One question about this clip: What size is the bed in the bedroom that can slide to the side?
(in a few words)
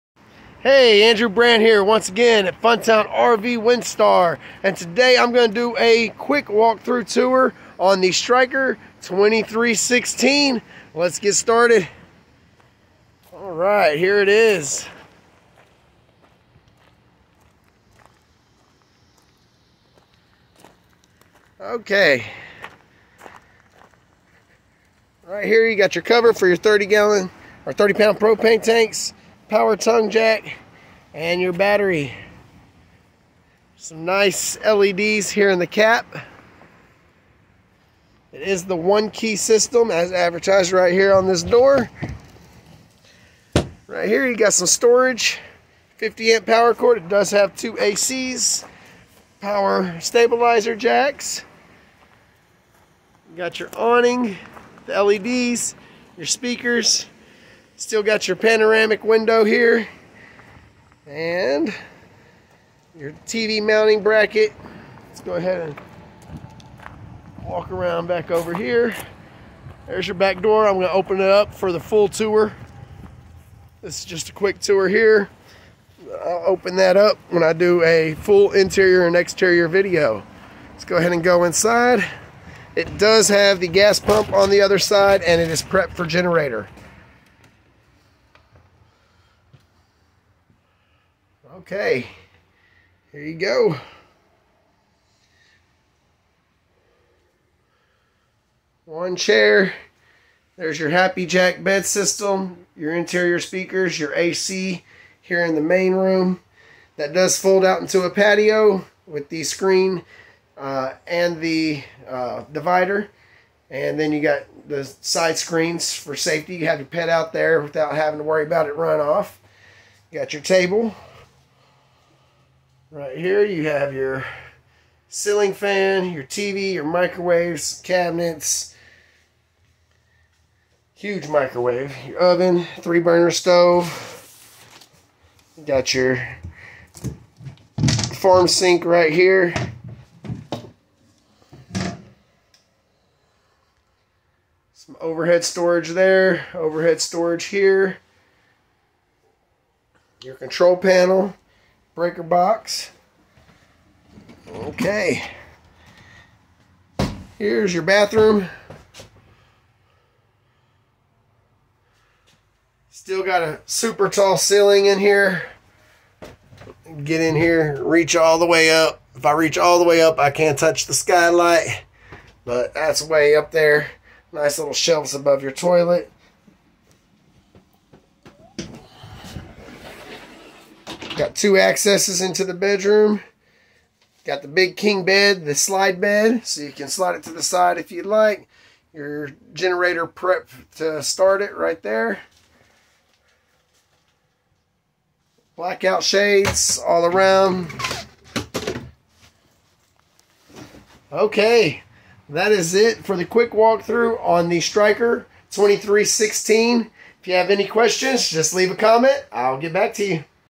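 King.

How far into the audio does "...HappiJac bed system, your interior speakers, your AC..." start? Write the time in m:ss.
1:40.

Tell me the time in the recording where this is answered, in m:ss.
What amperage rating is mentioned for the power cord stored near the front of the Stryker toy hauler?
0:45.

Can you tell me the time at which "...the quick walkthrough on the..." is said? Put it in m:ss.
3:23.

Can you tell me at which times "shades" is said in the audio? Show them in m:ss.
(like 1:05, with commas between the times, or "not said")
3:16.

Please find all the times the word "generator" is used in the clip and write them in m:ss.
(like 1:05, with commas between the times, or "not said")
1:26, 3:09.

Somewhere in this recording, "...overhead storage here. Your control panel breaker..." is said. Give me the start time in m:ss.
2:26.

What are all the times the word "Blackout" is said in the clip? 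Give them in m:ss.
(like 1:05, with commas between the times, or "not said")
3:15.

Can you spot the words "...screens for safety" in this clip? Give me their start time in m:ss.
1:55.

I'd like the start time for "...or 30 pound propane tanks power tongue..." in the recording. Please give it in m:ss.
0:27.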